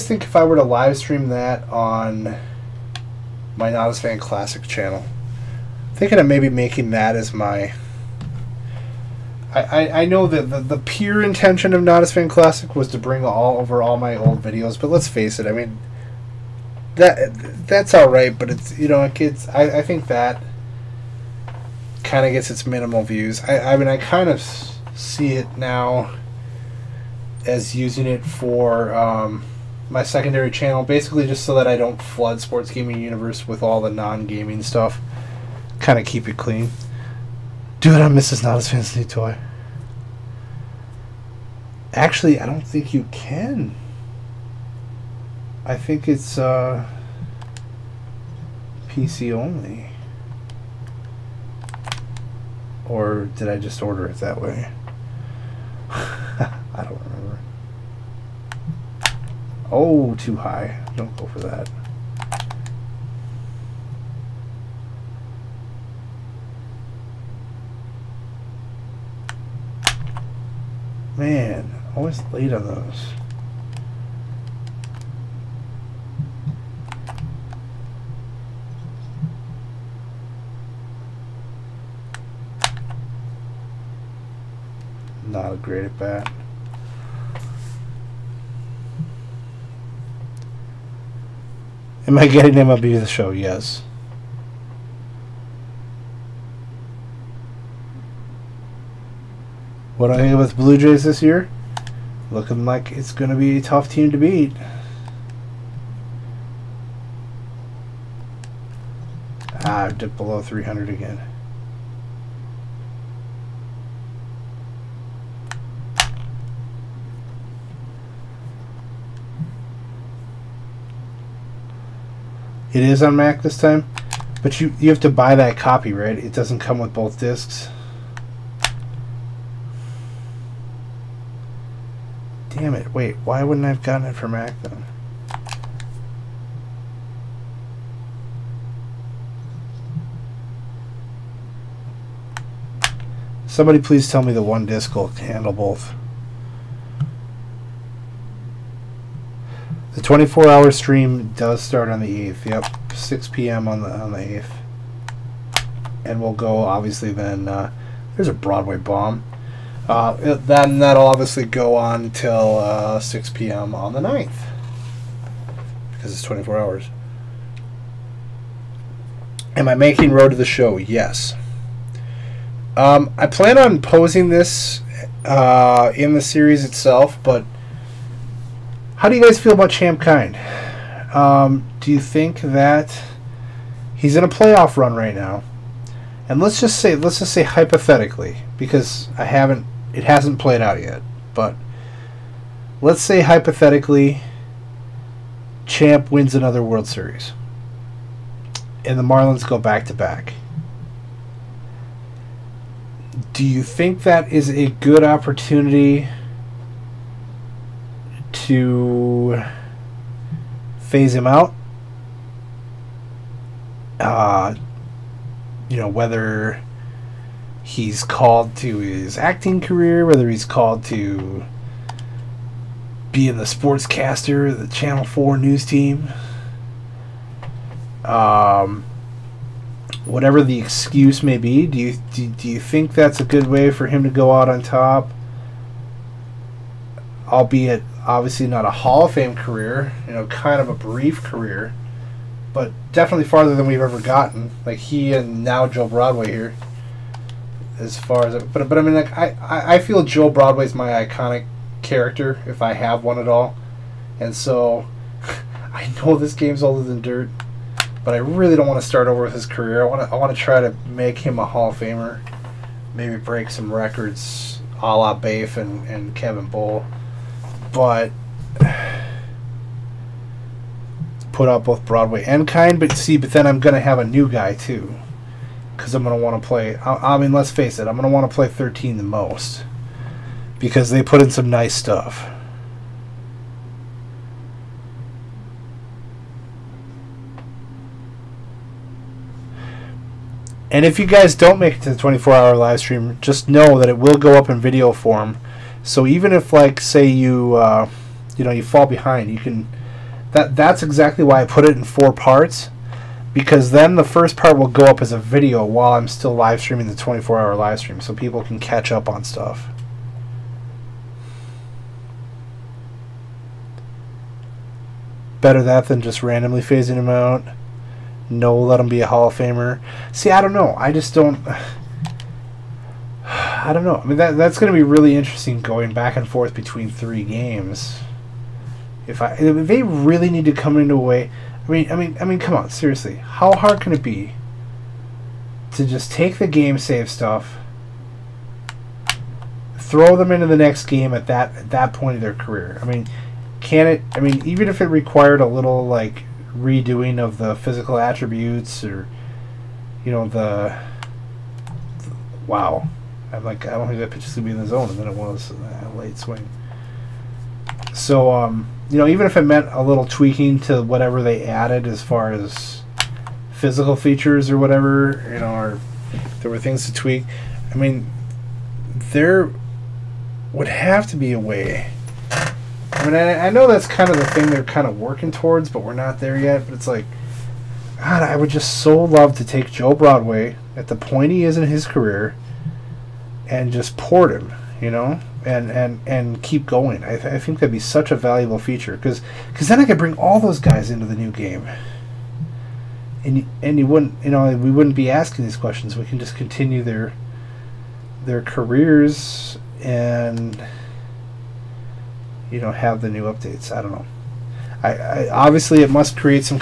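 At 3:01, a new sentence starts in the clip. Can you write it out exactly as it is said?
Um, do you think that he's in a playoff run right now?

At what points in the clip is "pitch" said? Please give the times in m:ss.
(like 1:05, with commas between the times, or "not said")
5:54.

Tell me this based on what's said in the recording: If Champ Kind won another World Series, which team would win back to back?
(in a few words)
Marlins.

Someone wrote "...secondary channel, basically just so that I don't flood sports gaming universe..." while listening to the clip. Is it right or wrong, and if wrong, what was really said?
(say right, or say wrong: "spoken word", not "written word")
right.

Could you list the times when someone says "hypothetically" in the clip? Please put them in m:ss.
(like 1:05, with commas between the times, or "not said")
3:07, 3:13.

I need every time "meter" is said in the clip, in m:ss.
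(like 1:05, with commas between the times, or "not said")
not said.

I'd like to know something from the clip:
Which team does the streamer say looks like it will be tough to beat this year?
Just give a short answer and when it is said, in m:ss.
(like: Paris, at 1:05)
Blue Jays, at 1:40.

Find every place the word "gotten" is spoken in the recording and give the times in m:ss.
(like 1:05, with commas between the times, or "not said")
2:13, 4:04.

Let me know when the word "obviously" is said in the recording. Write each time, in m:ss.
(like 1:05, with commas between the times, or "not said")
2:36, 2:41, 3:58, 6:45.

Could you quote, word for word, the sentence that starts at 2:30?
24 hour stream does start on the 8th.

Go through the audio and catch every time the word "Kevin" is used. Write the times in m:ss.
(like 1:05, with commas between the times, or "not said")
4:26.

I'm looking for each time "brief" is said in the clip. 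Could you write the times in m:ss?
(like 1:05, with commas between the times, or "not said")
4:00.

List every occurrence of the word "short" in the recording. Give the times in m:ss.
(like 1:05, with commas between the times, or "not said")
not said.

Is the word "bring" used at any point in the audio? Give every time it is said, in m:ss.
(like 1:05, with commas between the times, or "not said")
0:12, 6:29.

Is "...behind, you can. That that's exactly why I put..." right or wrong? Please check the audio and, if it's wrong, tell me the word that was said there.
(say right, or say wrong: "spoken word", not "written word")
right.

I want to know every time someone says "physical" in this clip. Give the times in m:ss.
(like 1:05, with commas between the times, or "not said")
5:47, 6:03.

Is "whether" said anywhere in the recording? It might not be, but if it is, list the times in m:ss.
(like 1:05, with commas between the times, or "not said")
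3:35, 3:40.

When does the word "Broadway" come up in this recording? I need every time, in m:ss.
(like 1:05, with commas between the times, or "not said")
2:38, 4:05, 4:10, 4:31, 6:19.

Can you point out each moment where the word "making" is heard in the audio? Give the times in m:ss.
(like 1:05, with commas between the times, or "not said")
0:06, 2:49.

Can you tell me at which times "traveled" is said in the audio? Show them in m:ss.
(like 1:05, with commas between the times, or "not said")
not said.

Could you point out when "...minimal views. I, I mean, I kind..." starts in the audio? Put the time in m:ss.
0:22.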